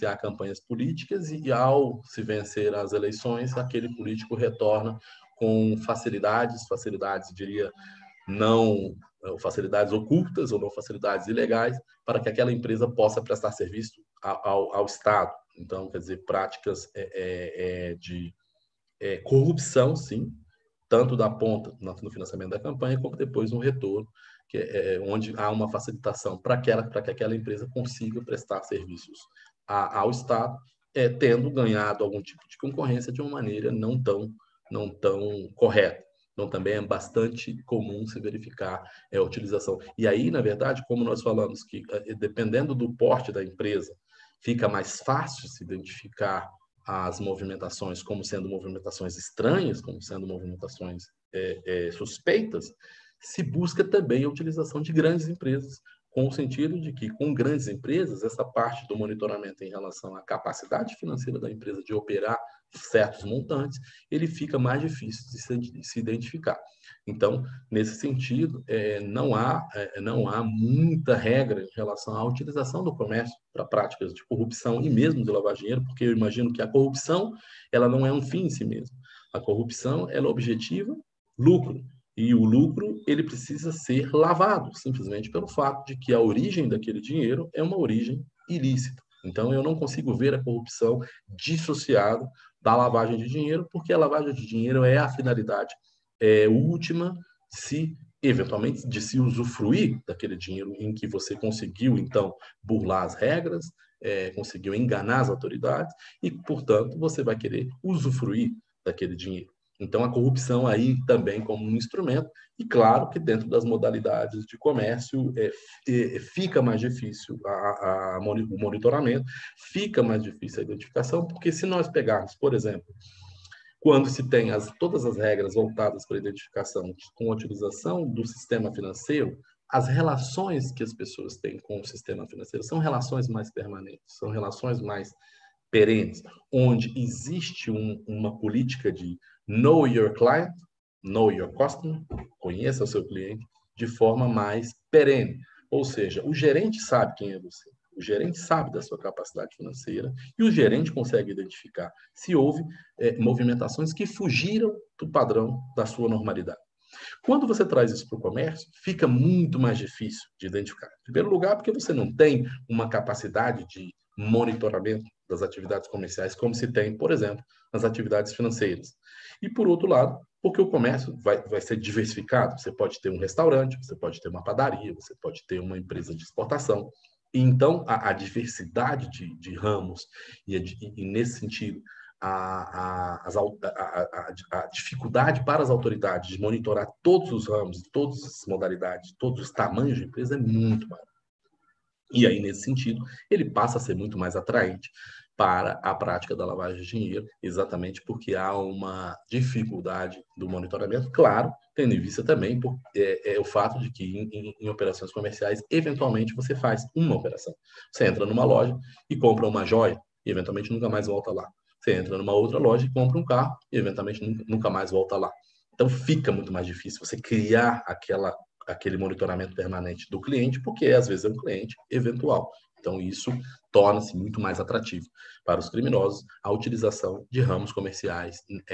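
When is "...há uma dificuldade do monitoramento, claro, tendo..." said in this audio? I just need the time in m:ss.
3:18.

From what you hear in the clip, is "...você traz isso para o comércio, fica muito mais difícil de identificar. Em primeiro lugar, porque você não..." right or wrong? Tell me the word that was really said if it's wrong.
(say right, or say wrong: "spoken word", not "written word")
right.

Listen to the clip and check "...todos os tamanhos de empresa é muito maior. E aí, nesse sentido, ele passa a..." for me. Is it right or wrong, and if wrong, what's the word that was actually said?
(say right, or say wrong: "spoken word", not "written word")
right.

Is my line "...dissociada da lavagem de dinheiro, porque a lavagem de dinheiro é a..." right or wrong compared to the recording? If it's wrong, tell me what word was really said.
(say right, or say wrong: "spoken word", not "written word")
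right.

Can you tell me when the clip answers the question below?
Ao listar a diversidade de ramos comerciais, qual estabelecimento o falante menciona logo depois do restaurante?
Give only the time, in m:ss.
2:54.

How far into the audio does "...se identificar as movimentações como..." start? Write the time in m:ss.
0:45.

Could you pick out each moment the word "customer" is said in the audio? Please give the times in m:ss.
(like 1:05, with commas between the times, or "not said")
2:21.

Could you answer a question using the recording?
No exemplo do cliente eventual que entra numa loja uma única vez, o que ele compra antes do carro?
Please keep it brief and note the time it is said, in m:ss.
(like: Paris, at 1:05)
Uma joia, at 3:29.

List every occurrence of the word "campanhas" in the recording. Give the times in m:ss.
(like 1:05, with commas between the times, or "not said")
0:00, 0:22.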